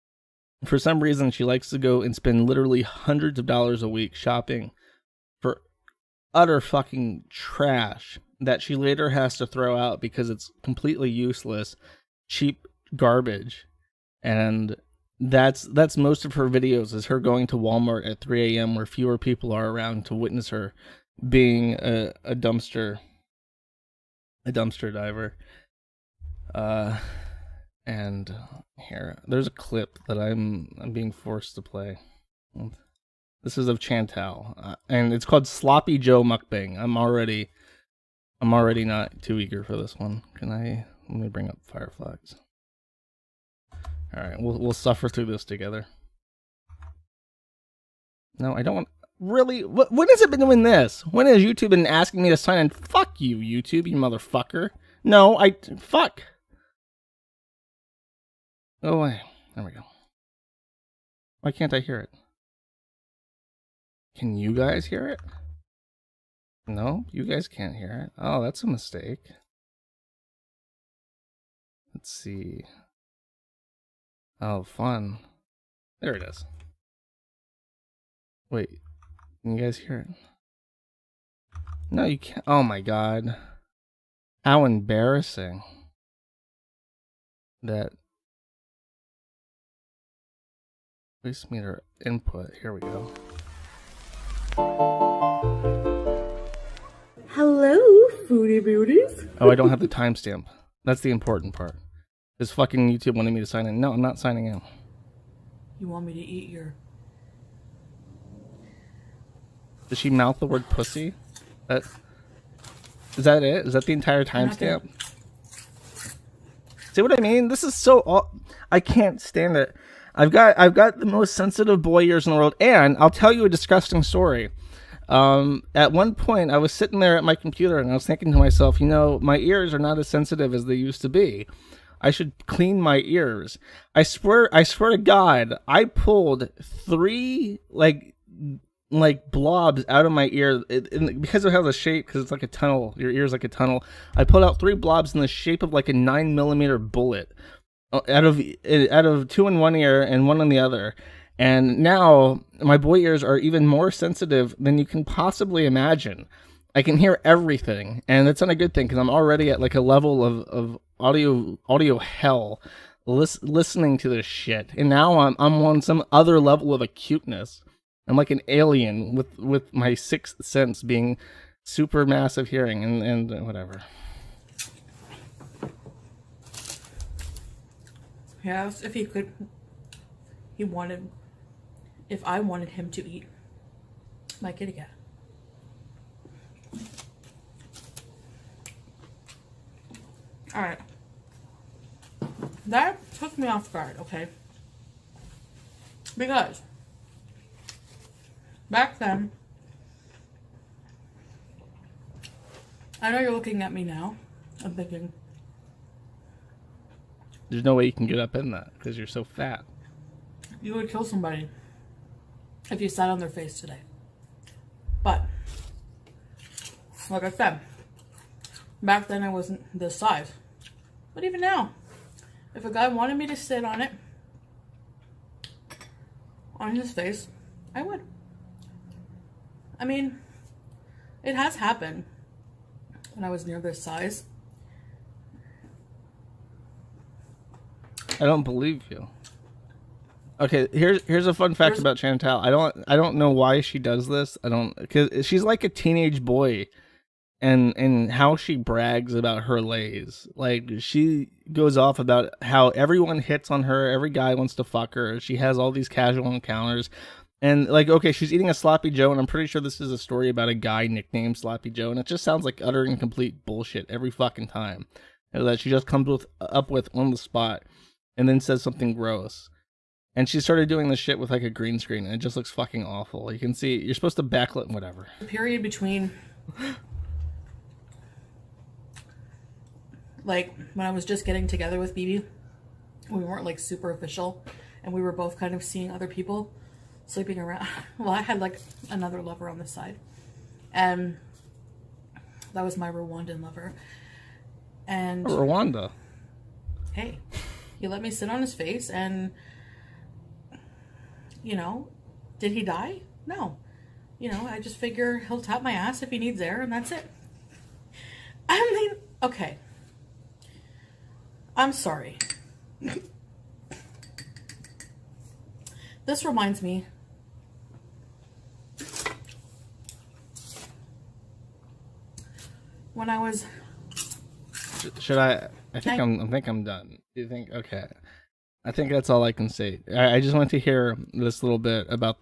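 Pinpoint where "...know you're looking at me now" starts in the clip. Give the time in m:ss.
3:23.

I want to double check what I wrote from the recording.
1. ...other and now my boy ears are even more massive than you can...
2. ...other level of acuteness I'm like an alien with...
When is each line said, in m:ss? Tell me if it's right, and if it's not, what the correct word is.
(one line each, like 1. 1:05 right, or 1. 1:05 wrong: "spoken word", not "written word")
1. 2:30 wrong: "sensitive", not "massive"
2. 2:46 right.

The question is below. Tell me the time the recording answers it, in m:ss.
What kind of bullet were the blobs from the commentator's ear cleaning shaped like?
2:25.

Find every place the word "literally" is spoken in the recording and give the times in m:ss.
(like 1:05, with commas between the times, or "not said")
0:02.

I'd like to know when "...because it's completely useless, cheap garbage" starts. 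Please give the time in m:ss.
0:09.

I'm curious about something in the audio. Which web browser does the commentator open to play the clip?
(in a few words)
Firefox.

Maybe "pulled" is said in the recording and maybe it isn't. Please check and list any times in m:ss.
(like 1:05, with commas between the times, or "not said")
2:15, 2:24.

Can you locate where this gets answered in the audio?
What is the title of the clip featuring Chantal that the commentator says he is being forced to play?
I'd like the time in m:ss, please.
0:35.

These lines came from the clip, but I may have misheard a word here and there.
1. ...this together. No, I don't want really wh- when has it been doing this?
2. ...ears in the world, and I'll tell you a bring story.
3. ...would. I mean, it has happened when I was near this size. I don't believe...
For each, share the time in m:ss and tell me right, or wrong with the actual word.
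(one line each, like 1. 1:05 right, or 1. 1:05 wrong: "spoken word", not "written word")
1. 0:45 right
2. 2:02 wrong: "disgusting", not "bring"
3. 3:47 right.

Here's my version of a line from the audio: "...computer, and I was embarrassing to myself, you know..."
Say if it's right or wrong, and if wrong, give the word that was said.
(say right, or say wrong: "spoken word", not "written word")
wrong: "thinking", not "embarrassing".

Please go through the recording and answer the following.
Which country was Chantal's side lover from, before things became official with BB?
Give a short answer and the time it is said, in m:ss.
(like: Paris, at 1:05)
Rwanda, at 4:52.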